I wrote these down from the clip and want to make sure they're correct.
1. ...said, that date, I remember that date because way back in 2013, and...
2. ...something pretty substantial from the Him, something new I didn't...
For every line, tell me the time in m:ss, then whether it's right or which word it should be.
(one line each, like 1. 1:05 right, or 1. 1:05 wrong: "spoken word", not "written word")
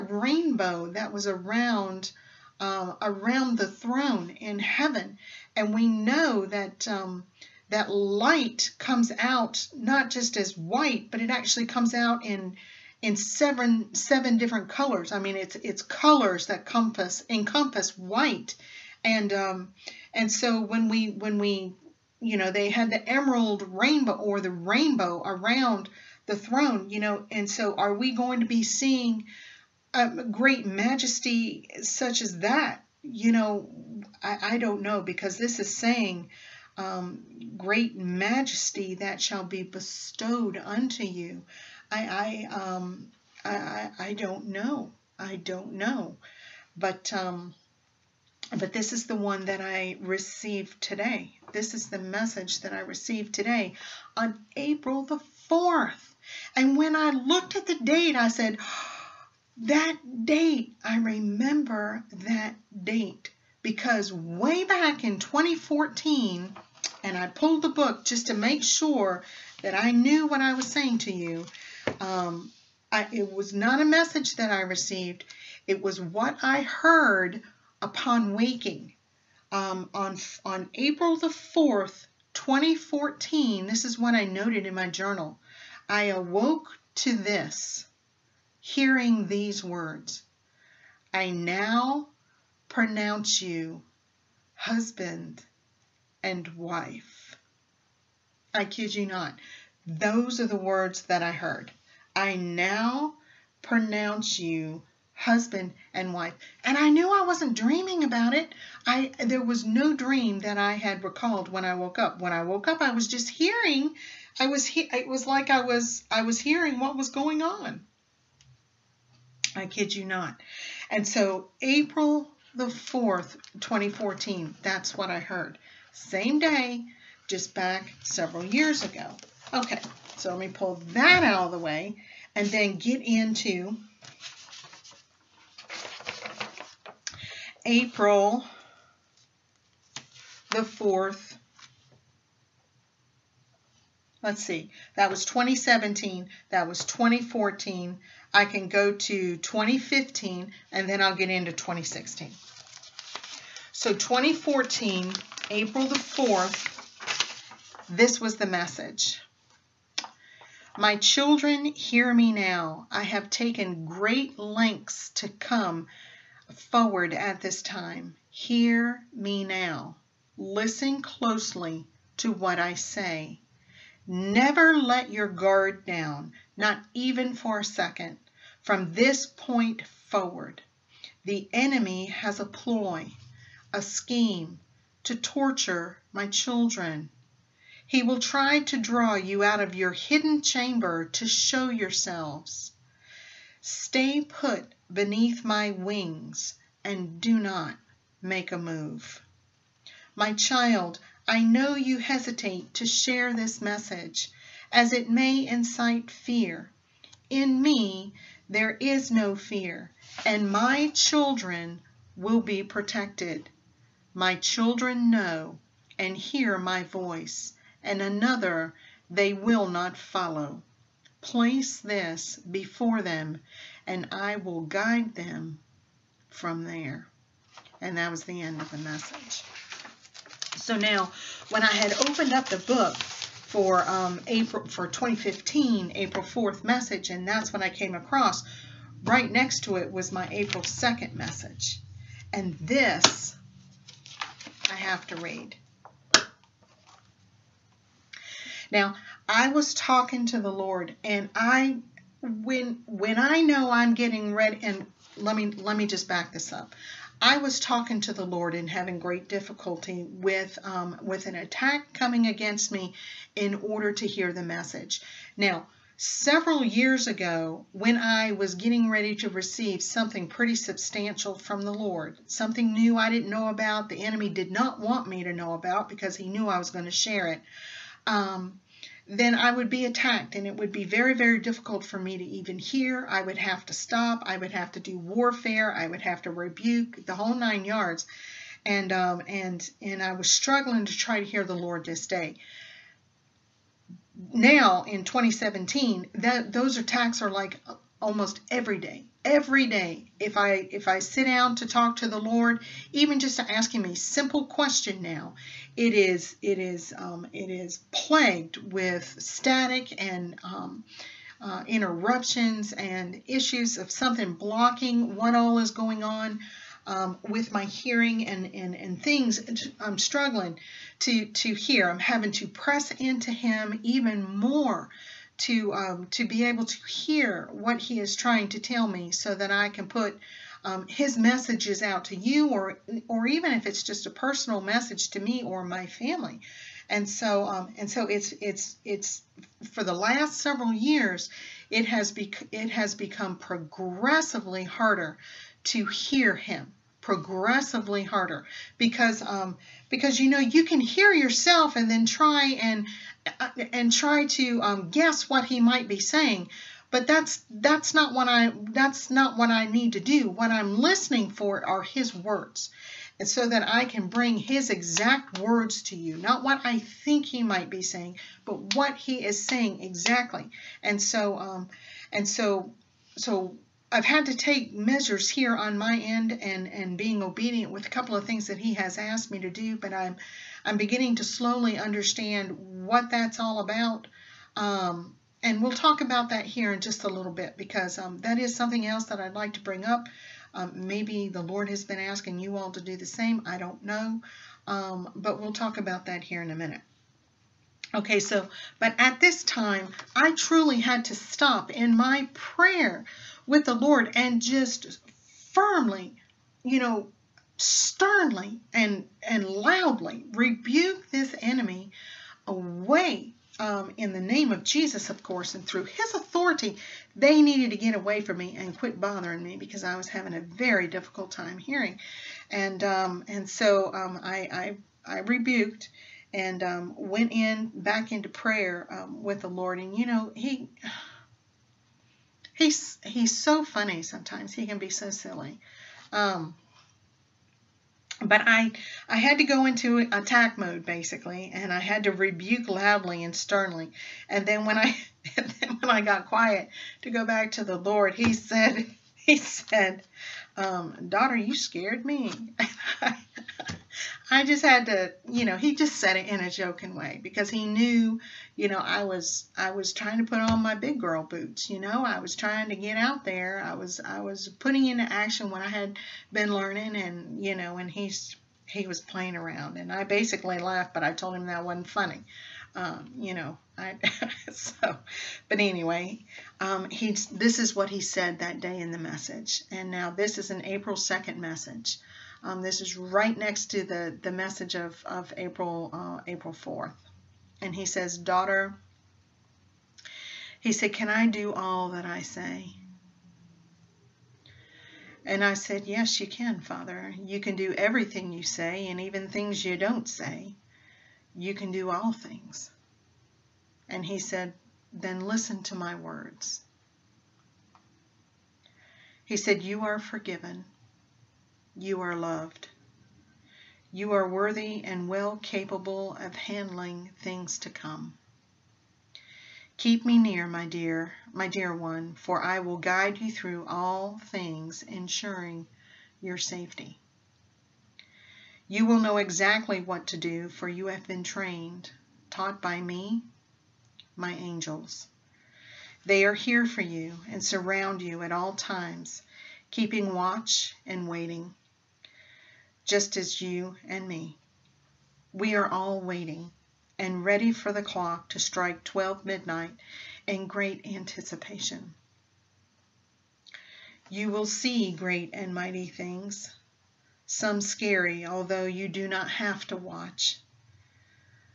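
1. 0:58 wrong: "2014", not "2013"
2. 4:29 wrong: "Lord", not "Him".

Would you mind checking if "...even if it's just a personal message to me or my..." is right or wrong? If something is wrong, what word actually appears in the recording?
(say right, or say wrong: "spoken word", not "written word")
right.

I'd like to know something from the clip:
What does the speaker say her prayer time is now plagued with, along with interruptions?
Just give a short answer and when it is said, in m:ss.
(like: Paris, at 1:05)
static, at 5:09.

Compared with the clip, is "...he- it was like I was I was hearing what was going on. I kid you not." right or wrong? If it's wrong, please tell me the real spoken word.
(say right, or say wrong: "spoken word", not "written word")
right.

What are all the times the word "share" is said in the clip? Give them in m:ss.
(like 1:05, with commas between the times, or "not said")
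3:22, 4:37.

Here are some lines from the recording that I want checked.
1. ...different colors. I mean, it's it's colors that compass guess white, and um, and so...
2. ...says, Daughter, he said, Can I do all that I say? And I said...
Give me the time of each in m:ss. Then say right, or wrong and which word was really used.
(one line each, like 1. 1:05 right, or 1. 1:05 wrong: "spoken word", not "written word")
1. 0:14 wrong: "encompass", not "guess"
2. 8:07 right.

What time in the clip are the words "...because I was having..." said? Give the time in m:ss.
6:59.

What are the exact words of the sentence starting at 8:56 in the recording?
They are here for you and surround you at all times, keeping watch and waiting just as you and me.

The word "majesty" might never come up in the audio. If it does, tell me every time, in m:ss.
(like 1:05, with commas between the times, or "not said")
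0:30, 0:37.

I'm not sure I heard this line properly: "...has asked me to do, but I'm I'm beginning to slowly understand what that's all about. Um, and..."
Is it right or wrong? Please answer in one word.
right.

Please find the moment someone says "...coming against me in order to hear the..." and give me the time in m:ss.
4:21.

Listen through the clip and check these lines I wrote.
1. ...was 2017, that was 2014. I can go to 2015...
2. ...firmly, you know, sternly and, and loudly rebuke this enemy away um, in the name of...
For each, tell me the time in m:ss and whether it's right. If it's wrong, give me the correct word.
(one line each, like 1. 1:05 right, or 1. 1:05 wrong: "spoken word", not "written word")
1. 2:25 right
2. 6:45 right.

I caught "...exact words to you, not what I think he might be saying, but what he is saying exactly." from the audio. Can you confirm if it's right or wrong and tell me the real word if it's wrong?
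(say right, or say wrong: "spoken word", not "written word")
right.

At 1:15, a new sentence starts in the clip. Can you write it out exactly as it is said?
It was what I heard upon waking um, on on April the fourth, 2014.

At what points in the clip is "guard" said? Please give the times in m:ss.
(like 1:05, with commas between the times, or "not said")
2:55.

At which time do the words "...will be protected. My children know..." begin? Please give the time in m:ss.
3:32.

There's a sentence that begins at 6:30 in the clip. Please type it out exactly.
Um, maybe the Lord has been asking you all to do the same.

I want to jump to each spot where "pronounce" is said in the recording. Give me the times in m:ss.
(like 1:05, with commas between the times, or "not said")
1:32, 1:43.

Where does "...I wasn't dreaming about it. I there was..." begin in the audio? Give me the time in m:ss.
1:47.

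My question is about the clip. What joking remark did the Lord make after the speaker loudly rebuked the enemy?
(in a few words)
Daughter, you scared me.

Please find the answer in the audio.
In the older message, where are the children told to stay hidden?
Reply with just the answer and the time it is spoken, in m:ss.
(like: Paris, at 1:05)
beneath my wings, at 3:14.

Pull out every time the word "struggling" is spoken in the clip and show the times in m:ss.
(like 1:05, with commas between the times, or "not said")
4:50, 5:19.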